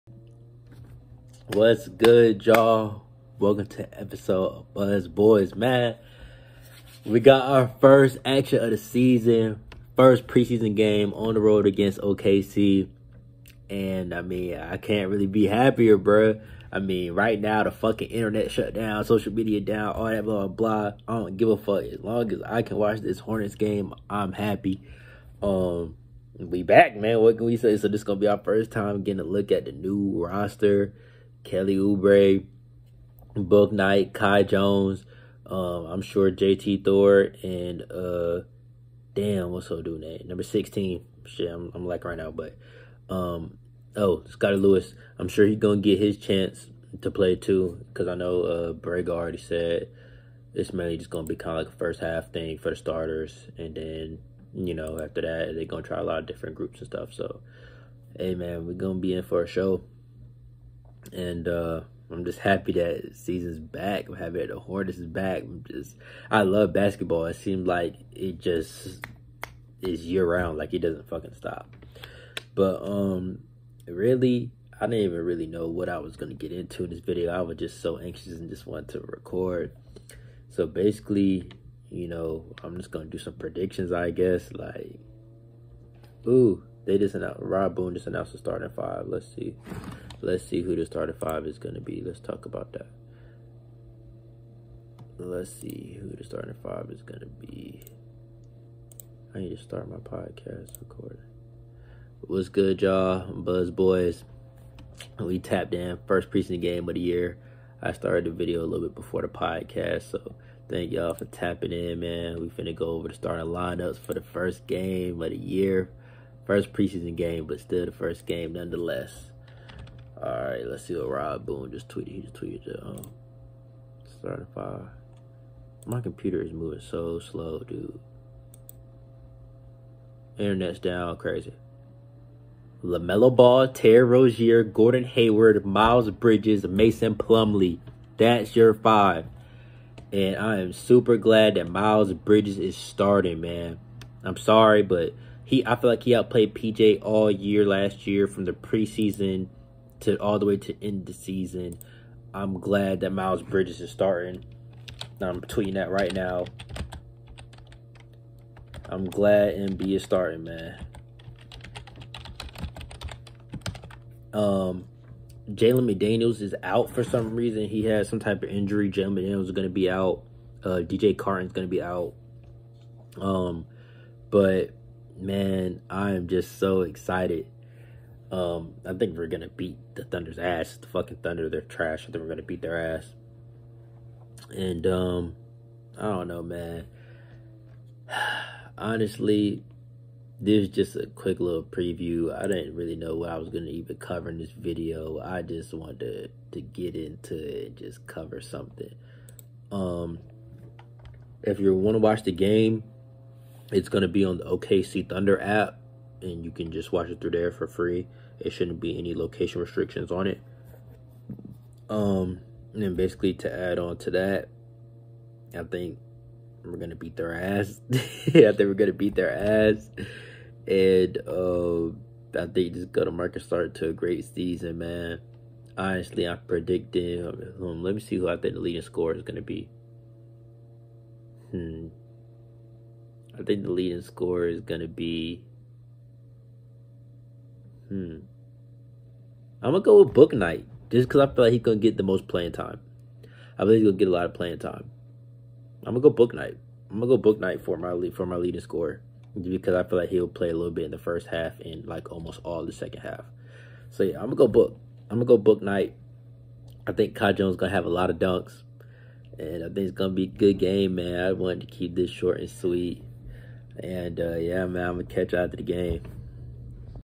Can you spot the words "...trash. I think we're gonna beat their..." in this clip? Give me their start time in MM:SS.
03:01.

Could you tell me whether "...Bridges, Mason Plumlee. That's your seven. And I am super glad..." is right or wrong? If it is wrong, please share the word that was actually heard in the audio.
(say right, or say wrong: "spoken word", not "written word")
wrong: "five", not "seven".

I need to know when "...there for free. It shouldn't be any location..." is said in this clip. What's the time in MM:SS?
03:27.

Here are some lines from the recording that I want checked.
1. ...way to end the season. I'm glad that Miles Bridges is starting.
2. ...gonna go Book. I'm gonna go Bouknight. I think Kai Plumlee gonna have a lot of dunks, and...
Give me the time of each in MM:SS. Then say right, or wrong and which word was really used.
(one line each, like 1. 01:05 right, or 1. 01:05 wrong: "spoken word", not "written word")
1. 02:30 right
2. 04:14 wrong: "Jones", not "Plumlee".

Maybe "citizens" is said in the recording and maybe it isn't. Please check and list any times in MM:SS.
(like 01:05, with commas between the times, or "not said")
not said.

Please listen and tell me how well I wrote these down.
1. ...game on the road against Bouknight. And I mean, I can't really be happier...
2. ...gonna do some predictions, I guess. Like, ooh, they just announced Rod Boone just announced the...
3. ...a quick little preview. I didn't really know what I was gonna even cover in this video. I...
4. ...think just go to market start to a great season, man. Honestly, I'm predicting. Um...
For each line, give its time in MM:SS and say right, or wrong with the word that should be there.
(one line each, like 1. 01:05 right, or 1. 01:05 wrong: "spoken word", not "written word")
1. 00:10 wrong: "OKC", not "Bouknight"
2. 01:22 right
3. 03:10 right
4. 03:42 right.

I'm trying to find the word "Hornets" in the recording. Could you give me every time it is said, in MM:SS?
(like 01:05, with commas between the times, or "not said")
00:23, 01:04.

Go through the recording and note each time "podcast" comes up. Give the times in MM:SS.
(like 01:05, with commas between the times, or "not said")
01:39, 01:49.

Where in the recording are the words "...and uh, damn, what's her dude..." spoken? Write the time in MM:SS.
00:37.